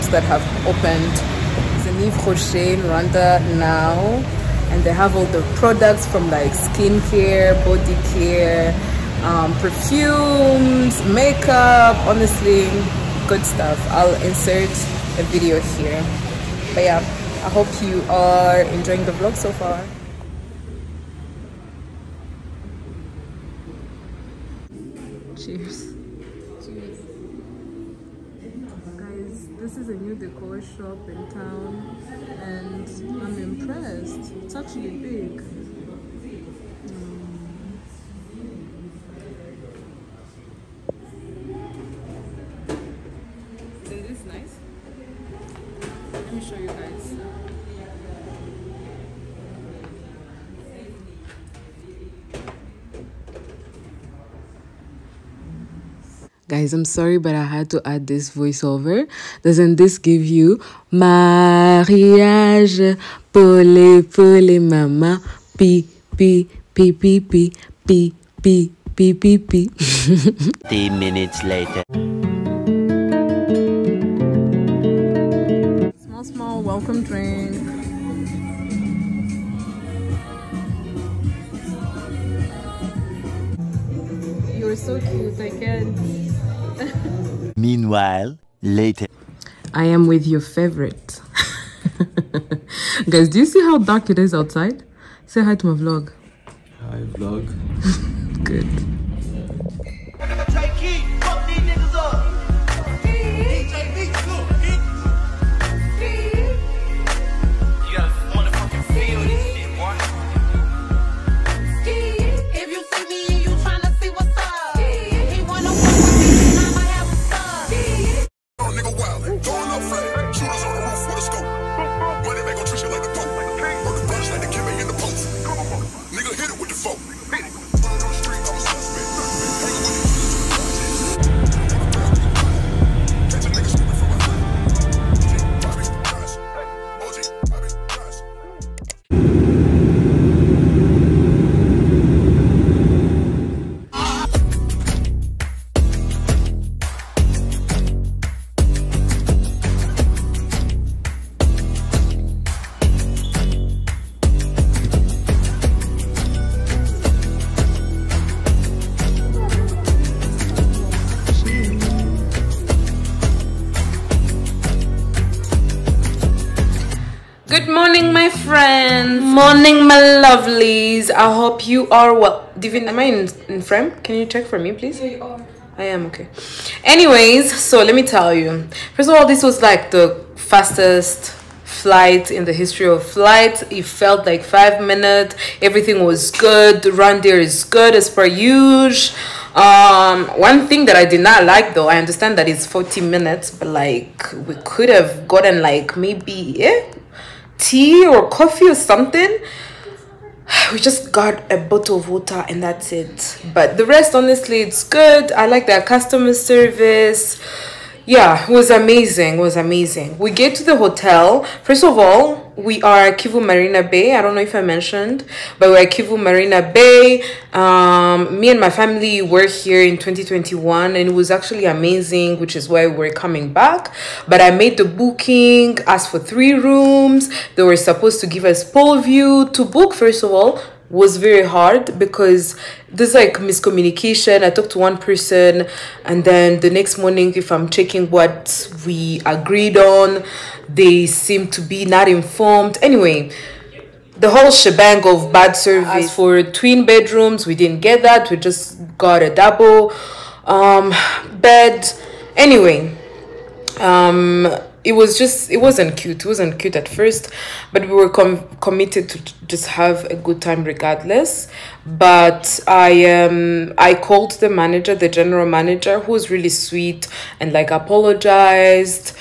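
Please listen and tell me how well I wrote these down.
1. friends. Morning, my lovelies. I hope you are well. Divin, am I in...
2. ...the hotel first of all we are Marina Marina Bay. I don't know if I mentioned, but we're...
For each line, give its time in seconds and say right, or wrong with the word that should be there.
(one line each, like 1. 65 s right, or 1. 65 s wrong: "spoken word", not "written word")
1. 168 s right
2. 210 s wrong: "Kivu", not "Marina".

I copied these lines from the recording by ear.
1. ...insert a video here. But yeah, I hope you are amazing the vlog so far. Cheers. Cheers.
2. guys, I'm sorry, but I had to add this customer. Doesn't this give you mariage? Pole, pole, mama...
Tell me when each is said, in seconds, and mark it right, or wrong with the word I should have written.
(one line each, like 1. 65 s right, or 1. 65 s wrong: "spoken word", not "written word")
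1. 14 s wrong: "enjoying", not "amazing"
2. 56 s wrong: "voiceover", not "customer".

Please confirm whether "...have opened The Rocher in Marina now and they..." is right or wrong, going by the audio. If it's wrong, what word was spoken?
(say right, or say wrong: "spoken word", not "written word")
wrong: "Rwanda", not "Marina".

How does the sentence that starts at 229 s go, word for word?
To book, first of all, was very hard because there's like miscommunication.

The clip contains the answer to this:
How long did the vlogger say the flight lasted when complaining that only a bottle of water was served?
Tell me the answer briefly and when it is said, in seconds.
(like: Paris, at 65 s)
40 minutes, at 192 s.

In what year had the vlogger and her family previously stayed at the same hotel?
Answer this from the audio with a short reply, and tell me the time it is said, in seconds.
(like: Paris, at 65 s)
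2021, at 219 s.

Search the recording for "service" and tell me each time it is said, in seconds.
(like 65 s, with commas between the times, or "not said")
206 s, 245 s.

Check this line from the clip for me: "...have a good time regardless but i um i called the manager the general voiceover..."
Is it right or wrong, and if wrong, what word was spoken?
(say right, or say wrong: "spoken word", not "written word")
wrong: "manager", not "voiceover".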